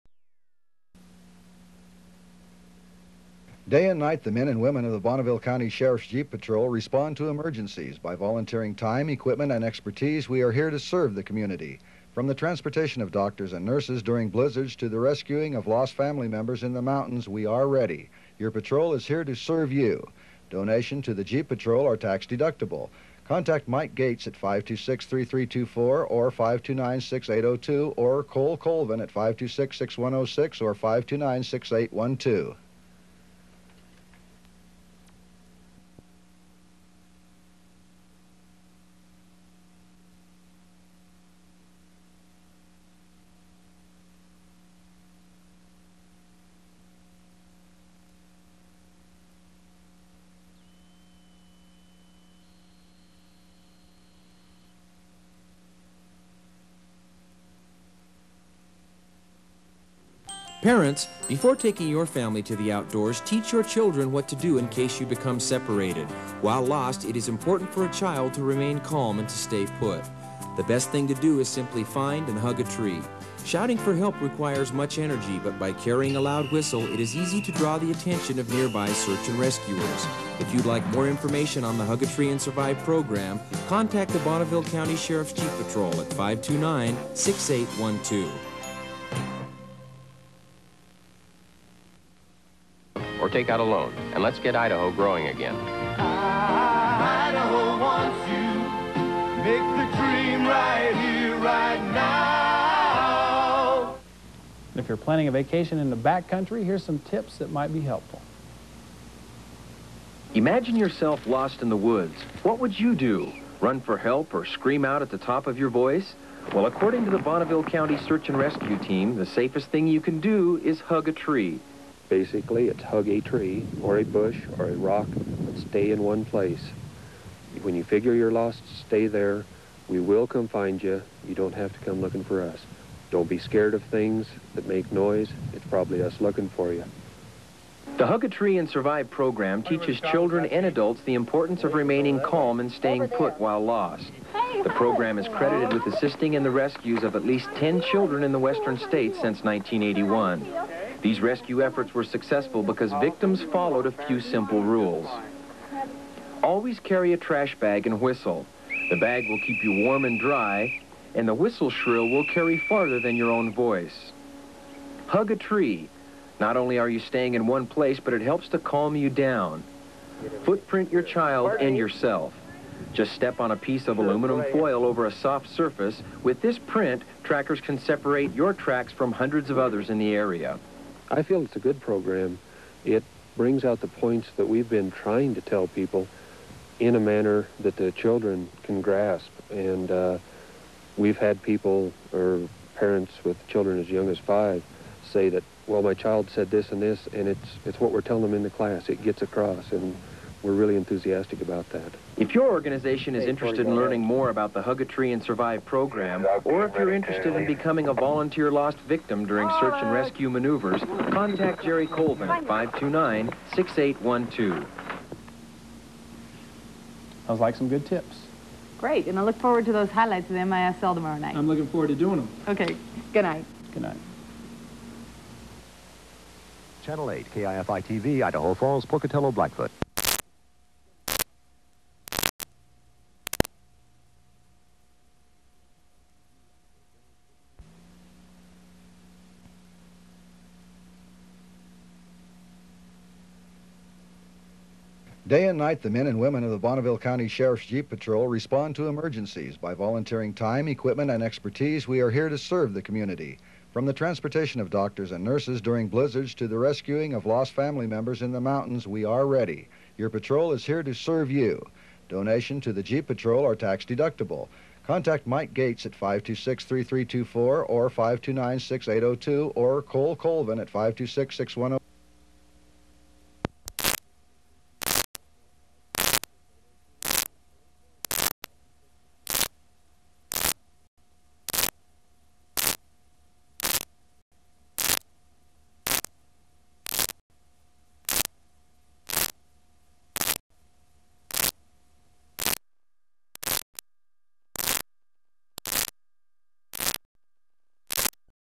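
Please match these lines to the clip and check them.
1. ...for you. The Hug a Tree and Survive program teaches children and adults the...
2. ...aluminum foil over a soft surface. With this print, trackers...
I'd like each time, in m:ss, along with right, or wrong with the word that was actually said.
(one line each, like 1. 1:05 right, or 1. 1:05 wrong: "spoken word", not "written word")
1. 2:16 right
2. 2:53 right.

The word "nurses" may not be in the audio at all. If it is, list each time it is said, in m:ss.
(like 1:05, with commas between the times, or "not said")
0:13, 4:15.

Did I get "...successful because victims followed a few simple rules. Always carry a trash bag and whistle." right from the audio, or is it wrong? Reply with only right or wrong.
right.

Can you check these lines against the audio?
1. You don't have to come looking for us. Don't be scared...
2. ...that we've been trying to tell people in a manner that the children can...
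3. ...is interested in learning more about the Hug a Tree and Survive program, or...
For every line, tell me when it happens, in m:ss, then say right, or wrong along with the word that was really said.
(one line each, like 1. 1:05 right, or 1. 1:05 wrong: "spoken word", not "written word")
1. 2:11 right
2. 3:04 right
3. 3:23 right.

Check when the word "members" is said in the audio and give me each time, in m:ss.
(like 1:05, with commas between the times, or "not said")
0:16, 4:17.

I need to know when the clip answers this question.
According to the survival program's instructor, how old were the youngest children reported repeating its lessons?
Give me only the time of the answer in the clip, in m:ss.
3:14.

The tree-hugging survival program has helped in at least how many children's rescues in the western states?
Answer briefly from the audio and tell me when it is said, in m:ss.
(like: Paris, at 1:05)
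10, at 2:27.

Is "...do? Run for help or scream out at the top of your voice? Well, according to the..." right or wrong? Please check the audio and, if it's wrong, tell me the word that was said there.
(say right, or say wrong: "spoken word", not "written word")
right.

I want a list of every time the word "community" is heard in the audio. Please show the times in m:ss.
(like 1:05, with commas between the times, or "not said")
0:11, 4:12.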